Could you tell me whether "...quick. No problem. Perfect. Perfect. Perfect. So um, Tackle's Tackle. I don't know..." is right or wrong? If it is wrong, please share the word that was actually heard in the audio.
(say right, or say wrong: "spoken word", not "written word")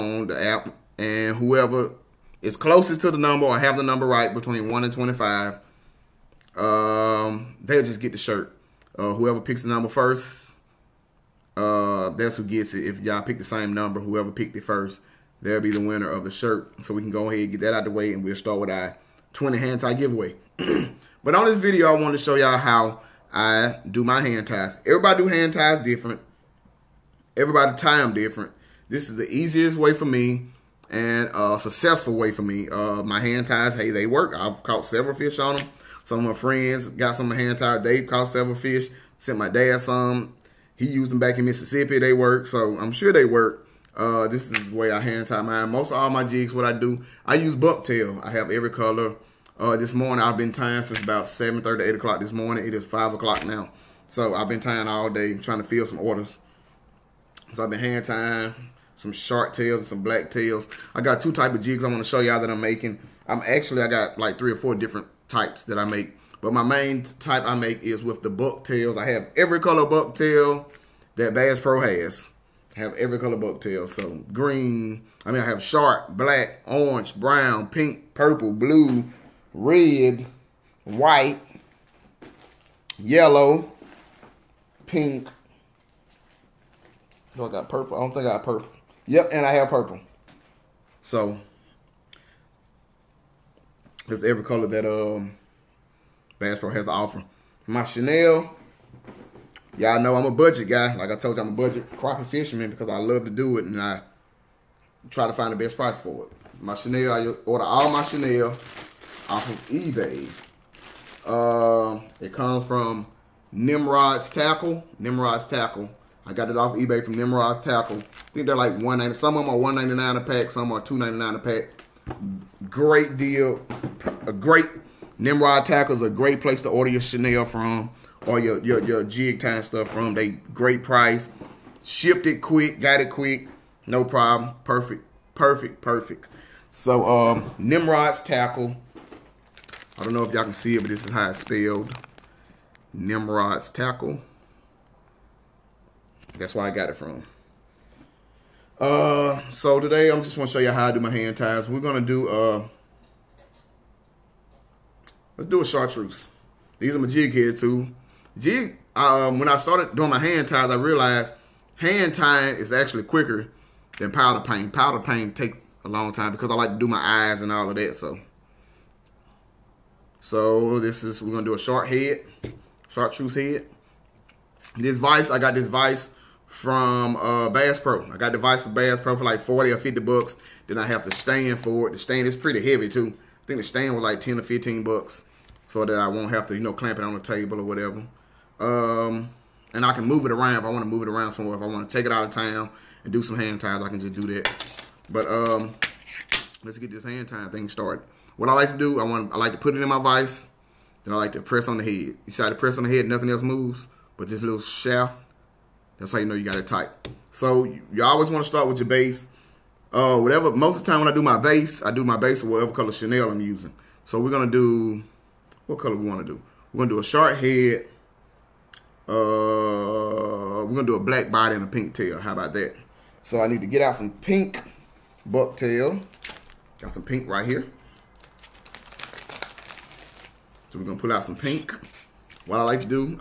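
wrong: "Nimrod", not "Tackle".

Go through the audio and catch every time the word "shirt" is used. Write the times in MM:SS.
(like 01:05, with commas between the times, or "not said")
00:08, 00:16.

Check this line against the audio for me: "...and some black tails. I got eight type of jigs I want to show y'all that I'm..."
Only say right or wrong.
wrong.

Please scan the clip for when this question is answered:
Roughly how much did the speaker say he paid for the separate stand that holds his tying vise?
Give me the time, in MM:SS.
03:04.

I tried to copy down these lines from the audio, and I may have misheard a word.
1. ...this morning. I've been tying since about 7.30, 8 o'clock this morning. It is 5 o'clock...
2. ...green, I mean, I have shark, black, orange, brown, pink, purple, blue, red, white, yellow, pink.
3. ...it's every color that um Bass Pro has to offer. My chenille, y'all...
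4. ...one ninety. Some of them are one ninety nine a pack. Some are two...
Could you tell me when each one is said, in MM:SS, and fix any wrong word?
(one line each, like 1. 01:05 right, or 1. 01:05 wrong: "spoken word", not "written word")
1. 00:49 right
2. 01:14 right
3. 01:34 right
4. 01:58 right.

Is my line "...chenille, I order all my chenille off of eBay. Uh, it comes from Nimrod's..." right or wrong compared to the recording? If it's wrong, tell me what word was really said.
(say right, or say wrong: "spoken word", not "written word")
right.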